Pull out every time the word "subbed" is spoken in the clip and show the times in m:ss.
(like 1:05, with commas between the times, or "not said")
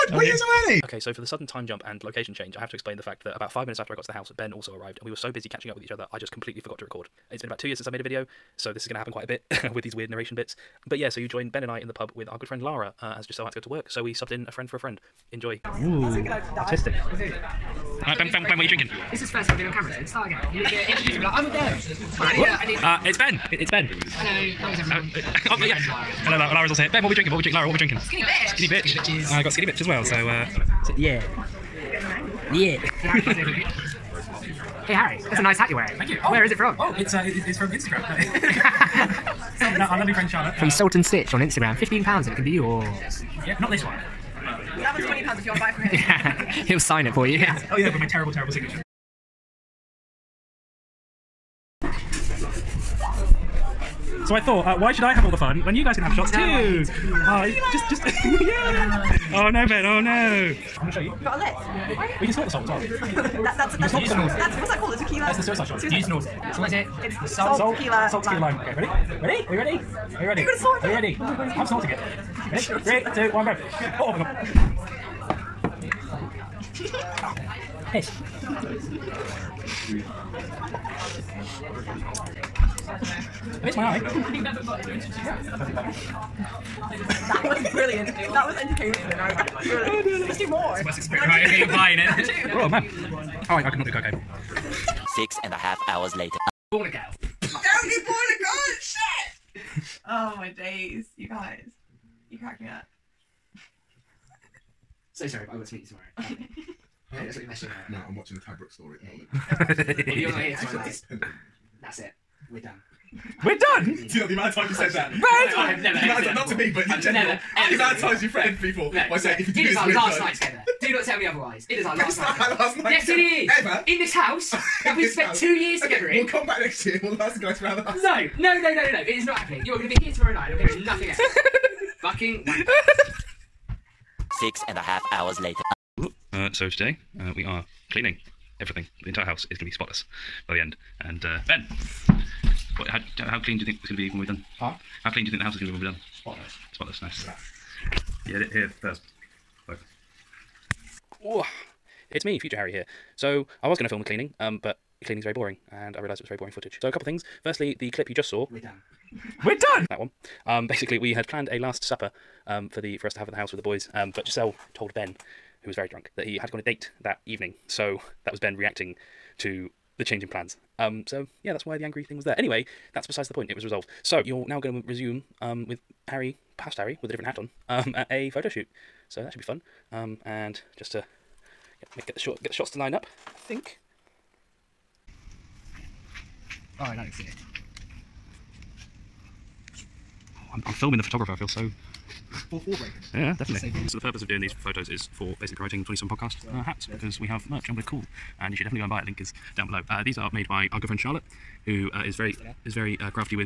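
0:14.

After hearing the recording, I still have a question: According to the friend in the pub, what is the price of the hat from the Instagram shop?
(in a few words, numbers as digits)
£15.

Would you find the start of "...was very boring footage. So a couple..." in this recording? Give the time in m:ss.
2:36.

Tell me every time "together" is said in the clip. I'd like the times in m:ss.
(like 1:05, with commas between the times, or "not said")
2:00, 2:05.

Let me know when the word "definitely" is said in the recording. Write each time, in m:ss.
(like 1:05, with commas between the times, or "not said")
3:13, 3:18.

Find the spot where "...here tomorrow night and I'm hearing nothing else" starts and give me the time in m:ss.
2:10.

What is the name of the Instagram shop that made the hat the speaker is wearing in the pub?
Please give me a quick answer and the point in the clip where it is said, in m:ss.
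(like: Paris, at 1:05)
Salt and Stitch, at 0:40.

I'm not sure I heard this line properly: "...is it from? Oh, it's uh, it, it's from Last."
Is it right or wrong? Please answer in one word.
wrong.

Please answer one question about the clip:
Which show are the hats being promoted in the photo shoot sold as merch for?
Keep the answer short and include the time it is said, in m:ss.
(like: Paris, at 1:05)
27 Podcast, at 3:15.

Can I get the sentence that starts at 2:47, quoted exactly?
So that was Ben reacting to the change in plans.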